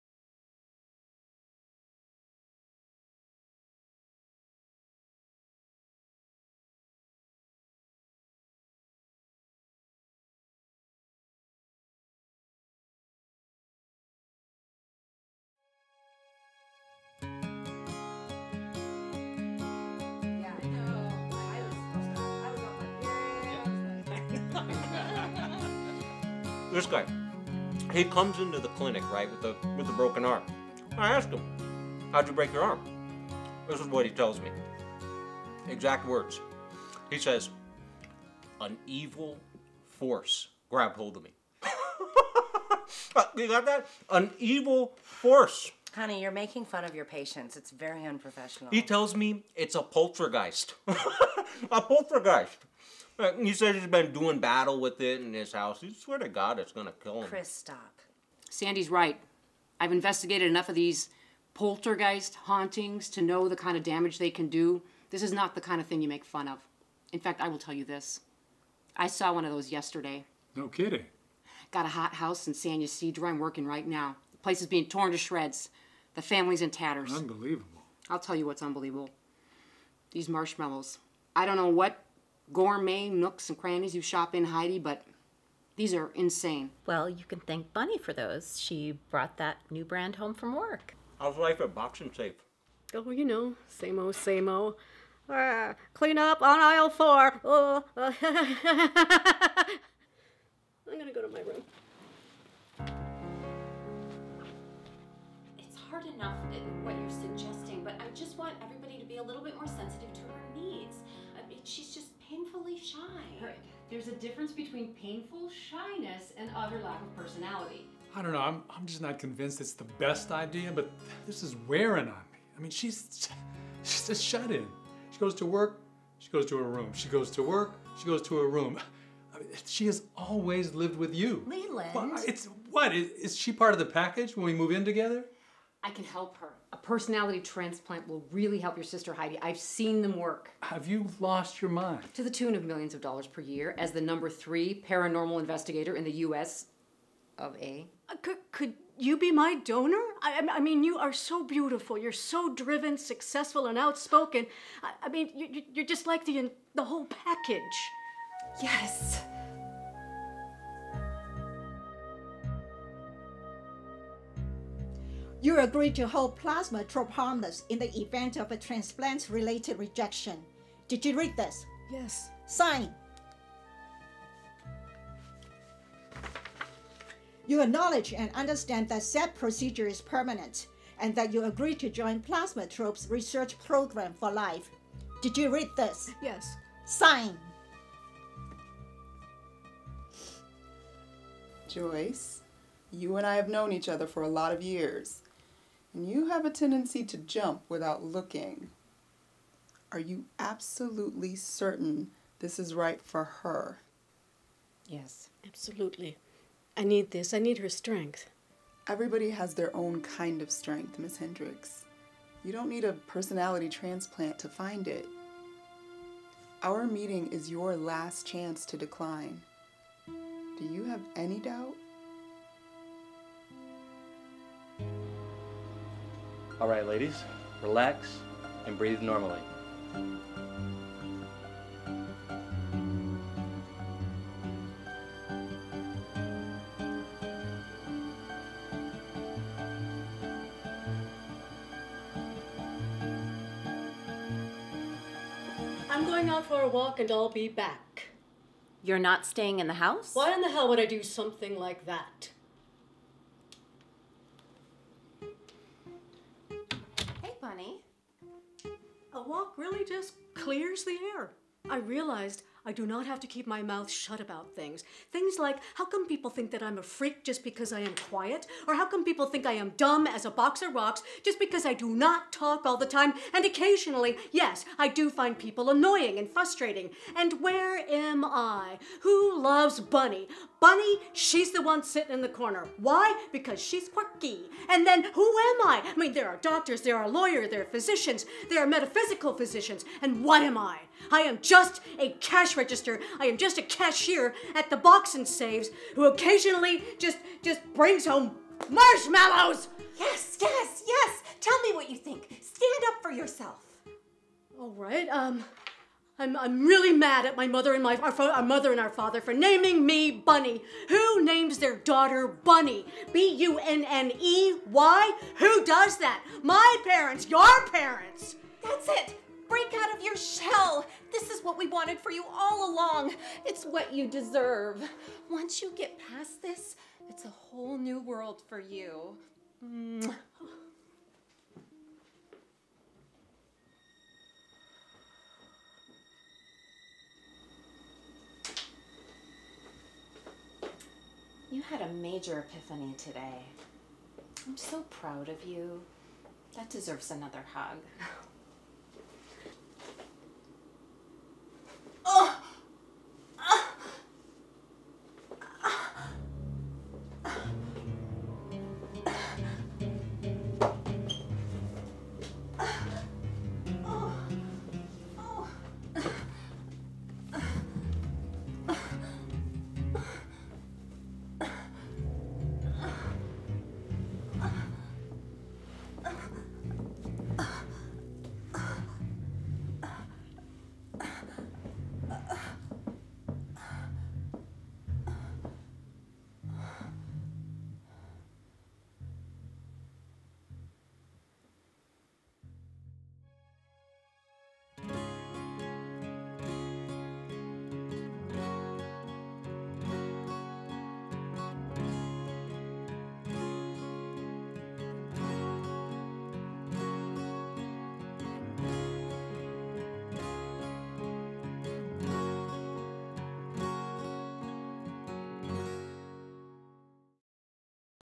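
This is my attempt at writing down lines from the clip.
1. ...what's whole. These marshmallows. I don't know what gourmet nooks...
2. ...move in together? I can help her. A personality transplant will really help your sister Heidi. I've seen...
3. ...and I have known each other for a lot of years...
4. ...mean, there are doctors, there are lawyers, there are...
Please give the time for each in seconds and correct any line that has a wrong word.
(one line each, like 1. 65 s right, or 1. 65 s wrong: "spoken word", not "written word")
1. 78 s wrong: "unbelievable", not "whole"
2. 134 s right
3. 193 s right
4. 285 s right.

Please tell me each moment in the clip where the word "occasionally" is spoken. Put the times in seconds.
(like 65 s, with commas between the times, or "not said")
273 s, 296 s.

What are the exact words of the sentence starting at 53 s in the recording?
He says he's been doing battle with it in his house.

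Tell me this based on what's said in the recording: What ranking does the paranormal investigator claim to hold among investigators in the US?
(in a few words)
number three.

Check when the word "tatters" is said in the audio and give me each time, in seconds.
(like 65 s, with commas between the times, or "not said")
76 s.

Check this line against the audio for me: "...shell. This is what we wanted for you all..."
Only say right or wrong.
right.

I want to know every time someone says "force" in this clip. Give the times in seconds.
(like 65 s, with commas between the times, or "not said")
39 s, 45 s.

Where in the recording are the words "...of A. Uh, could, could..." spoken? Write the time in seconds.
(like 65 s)
147 s.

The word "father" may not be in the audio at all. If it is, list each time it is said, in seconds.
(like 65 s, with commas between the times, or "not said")
308 s.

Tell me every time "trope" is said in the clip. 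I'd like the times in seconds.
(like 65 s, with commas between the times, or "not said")
166 s, 182 s.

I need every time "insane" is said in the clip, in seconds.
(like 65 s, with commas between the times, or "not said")
86 s.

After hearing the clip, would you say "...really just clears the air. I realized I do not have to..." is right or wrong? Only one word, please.
right.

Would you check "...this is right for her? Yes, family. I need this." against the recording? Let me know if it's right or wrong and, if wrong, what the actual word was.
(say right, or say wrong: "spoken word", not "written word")
wrong: "absolutely", not "family".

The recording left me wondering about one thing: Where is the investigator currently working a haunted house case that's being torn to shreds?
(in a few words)
San Ysidro.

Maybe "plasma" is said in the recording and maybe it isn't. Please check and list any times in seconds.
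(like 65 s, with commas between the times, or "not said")
166 s, 182 s.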